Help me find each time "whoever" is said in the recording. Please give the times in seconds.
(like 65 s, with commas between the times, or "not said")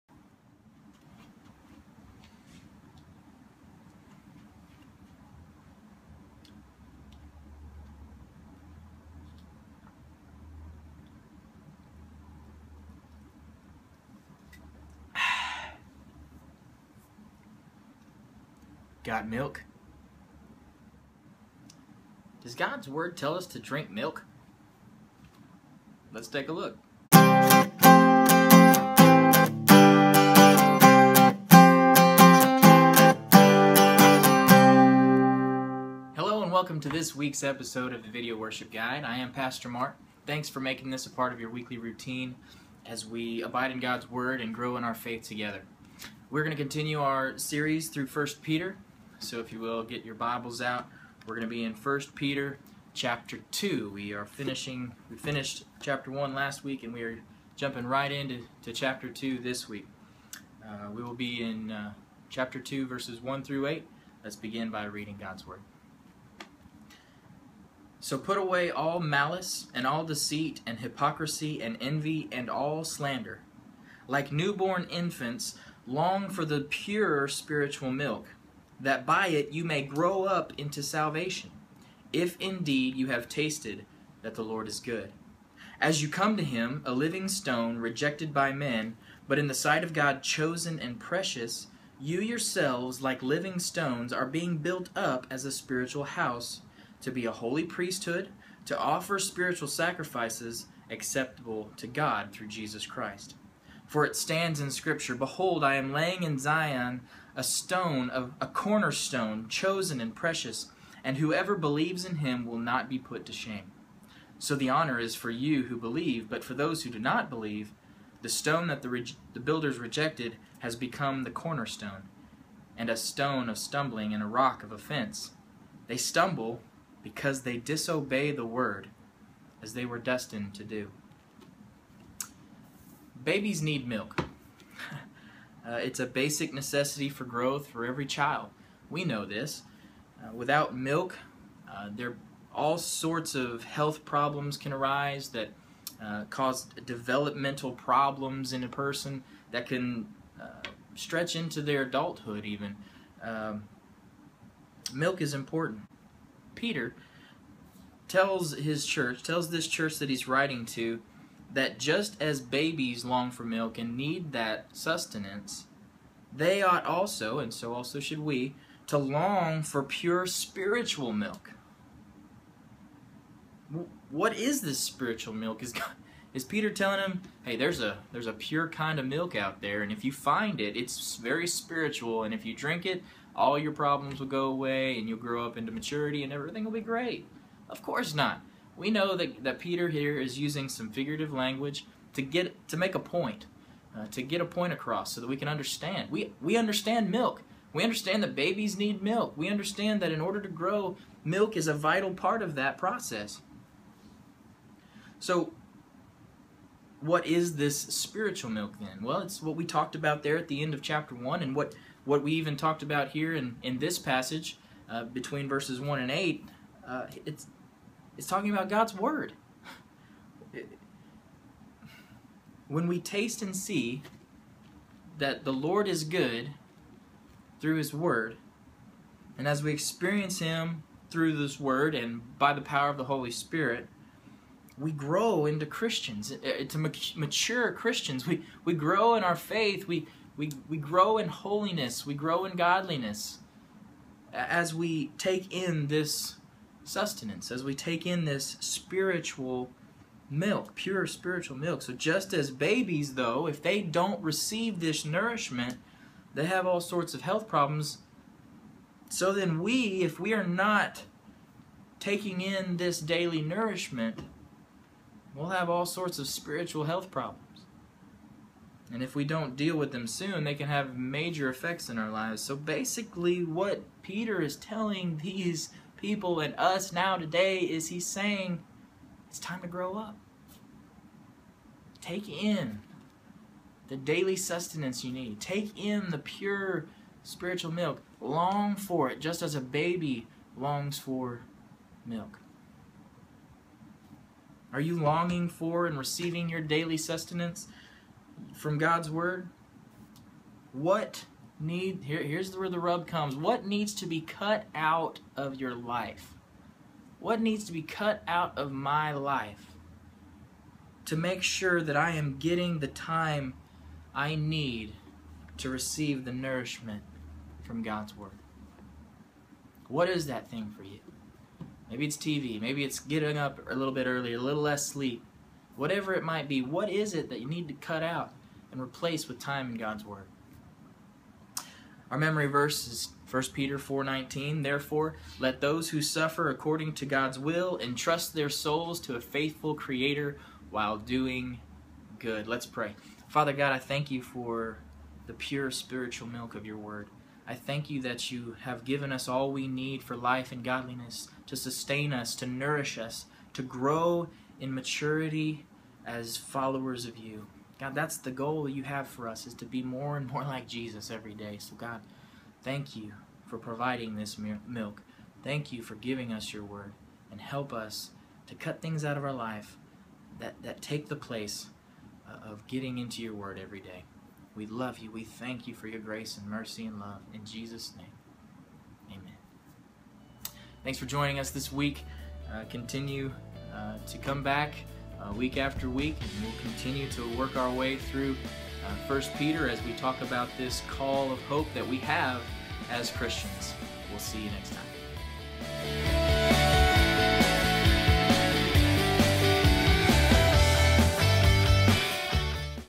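111 s.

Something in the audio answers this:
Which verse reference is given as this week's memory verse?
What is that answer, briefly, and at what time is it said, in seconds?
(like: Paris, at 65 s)
1 Peter 4:19, at 333 s.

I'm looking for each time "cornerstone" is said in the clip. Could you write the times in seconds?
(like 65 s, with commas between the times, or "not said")
108 s, 121 s.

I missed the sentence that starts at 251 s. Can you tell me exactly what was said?
So just as babies, though, if they don't receive this nourishment, they have all sorts of health problems.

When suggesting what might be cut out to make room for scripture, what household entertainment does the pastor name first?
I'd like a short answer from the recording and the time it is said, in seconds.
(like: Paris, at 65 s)
TV, at 322 s.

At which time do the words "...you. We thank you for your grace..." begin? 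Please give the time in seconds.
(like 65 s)
374 s.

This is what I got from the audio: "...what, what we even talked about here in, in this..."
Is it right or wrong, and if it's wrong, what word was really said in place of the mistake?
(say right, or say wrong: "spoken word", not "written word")
right.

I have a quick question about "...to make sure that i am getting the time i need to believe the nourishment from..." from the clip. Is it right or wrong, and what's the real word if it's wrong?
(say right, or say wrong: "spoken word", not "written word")
wrong: "receive", not "believe".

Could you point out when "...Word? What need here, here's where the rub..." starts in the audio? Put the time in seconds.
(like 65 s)
299 s.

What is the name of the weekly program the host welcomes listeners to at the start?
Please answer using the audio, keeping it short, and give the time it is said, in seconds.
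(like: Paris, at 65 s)
Video Worship Guide, at 38 s.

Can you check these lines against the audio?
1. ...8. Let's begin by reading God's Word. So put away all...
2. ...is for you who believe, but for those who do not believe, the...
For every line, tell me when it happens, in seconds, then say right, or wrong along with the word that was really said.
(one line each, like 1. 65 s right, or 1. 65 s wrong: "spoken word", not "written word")
1. 63 s right
2. 114 s right.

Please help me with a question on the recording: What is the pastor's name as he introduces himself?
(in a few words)
Pastor Mark.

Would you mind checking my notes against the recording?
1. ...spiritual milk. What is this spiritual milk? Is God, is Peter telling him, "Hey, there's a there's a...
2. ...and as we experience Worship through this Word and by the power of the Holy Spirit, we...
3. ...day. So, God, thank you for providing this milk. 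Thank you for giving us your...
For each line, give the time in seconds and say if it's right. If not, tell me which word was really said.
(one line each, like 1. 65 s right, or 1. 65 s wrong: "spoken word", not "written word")
1. 170 s right
2. 229 s wrong: "Him", not "Worship"
3. 361 s right.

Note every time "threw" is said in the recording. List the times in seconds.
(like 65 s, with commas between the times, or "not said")
not said.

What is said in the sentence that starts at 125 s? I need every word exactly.
They stumble because they disobey the word, as they were destined to do.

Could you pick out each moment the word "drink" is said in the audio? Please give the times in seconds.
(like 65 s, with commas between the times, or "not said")
23 s, 182 s.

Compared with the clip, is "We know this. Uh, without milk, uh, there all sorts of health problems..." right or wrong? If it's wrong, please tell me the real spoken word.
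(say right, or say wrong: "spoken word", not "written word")
right.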